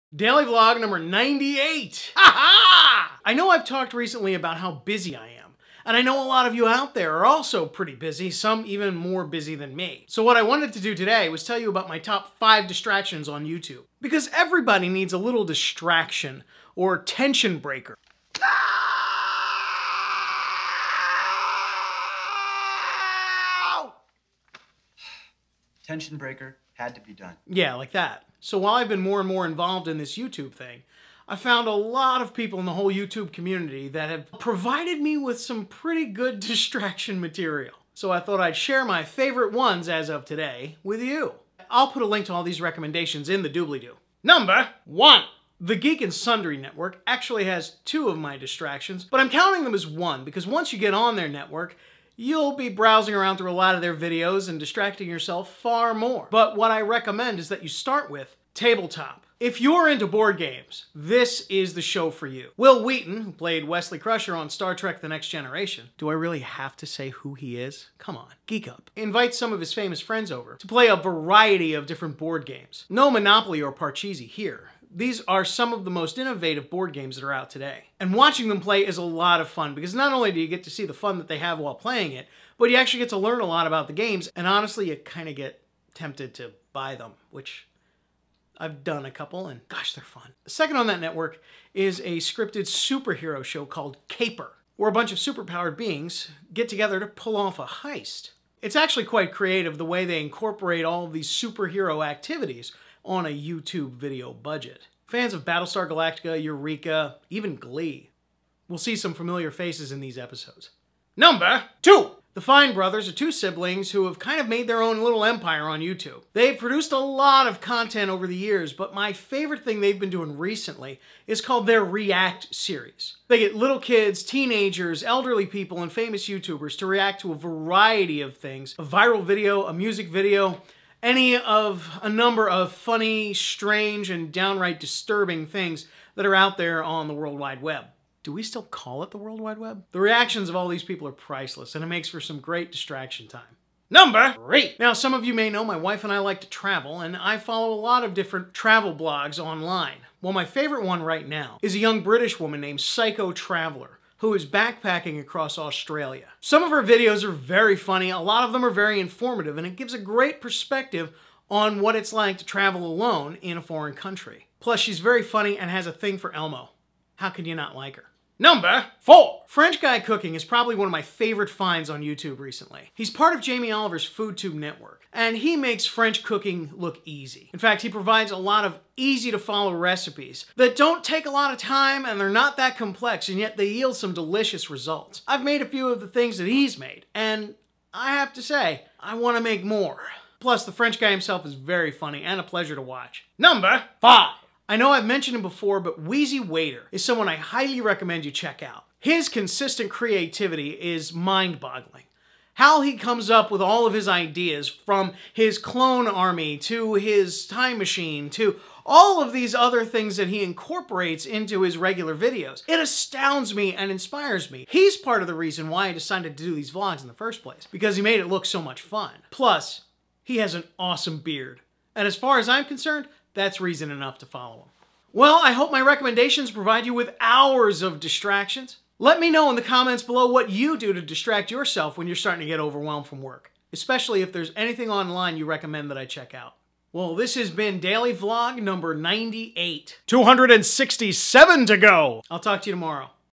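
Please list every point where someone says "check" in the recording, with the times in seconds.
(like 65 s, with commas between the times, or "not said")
198 s, 236 s.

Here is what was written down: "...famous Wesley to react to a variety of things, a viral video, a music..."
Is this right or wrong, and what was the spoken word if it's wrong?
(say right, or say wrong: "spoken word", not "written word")
wrong: "YouTubers", not "Wesley".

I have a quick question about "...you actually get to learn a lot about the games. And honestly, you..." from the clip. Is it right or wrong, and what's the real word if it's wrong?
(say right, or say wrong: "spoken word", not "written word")
right.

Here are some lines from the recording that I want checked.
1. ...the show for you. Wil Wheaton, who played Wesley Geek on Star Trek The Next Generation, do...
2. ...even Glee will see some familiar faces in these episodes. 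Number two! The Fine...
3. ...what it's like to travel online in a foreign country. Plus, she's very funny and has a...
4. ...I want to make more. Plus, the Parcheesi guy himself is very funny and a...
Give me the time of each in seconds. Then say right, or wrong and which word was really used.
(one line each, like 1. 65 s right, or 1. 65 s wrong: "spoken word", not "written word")
1. 61 s wrong: "Crusher", not "Geek"
2. 107 s right
3. 161 s wrong: "alone", not "online"
4. 188 s wrong: "French", not "Parcheesi".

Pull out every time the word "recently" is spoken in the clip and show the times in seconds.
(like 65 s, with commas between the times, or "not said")
3 s, 120 s, 172 s.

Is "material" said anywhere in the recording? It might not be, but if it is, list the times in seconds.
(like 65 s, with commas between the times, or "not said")
37 s.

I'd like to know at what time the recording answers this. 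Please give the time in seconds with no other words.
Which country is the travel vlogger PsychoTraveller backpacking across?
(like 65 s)
155 s.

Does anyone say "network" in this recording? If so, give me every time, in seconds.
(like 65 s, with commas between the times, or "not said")
46 s, 51 s, 91 s, 174 s.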